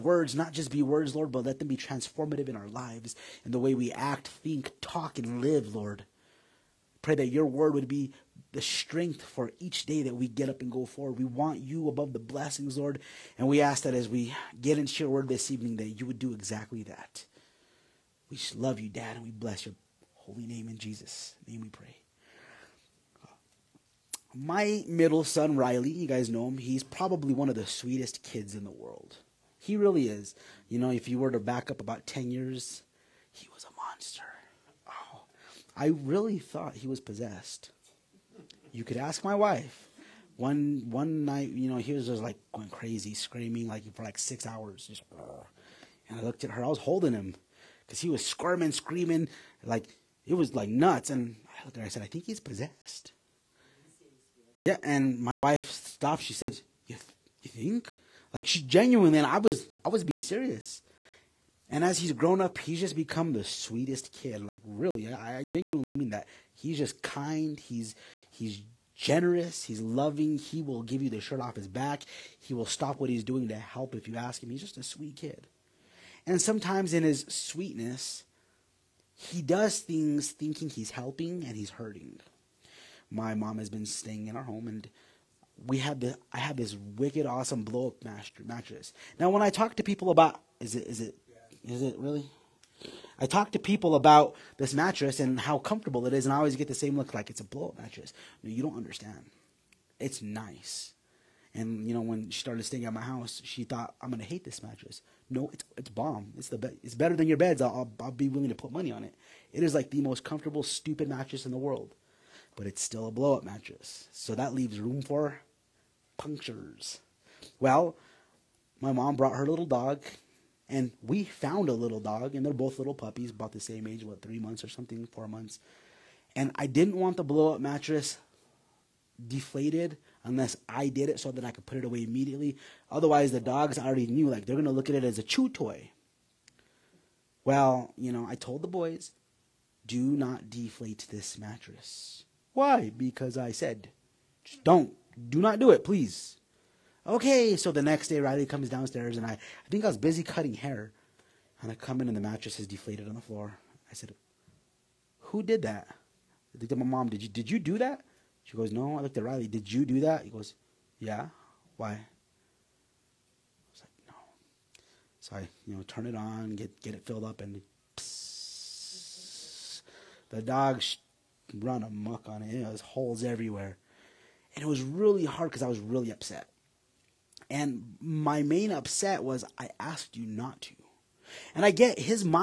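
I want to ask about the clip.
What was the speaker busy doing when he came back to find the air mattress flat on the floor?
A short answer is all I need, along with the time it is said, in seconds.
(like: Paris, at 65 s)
cutting hair, at 150 s.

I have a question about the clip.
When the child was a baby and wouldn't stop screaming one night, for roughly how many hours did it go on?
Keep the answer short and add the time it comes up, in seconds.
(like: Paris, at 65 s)
6, at 44 s.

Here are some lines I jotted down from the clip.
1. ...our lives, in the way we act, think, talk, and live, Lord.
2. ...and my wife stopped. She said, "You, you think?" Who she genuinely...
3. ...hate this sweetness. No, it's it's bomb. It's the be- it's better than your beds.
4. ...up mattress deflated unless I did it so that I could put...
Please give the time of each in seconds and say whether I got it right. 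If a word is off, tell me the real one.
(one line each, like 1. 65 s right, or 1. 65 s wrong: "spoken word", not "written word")
1. 2 s right
2. 54 s wrong: "Like", not "Who"
3. 104 s wrong: "mattress", not "sweetness"
4. 127 s right.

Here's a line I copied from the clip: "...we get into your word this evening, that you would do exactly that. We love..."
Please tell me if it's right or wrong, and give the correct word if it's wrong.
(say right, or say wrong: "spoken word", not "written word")
right.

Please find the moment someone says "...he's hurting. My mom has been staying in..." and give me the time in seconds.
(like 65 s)
81 s.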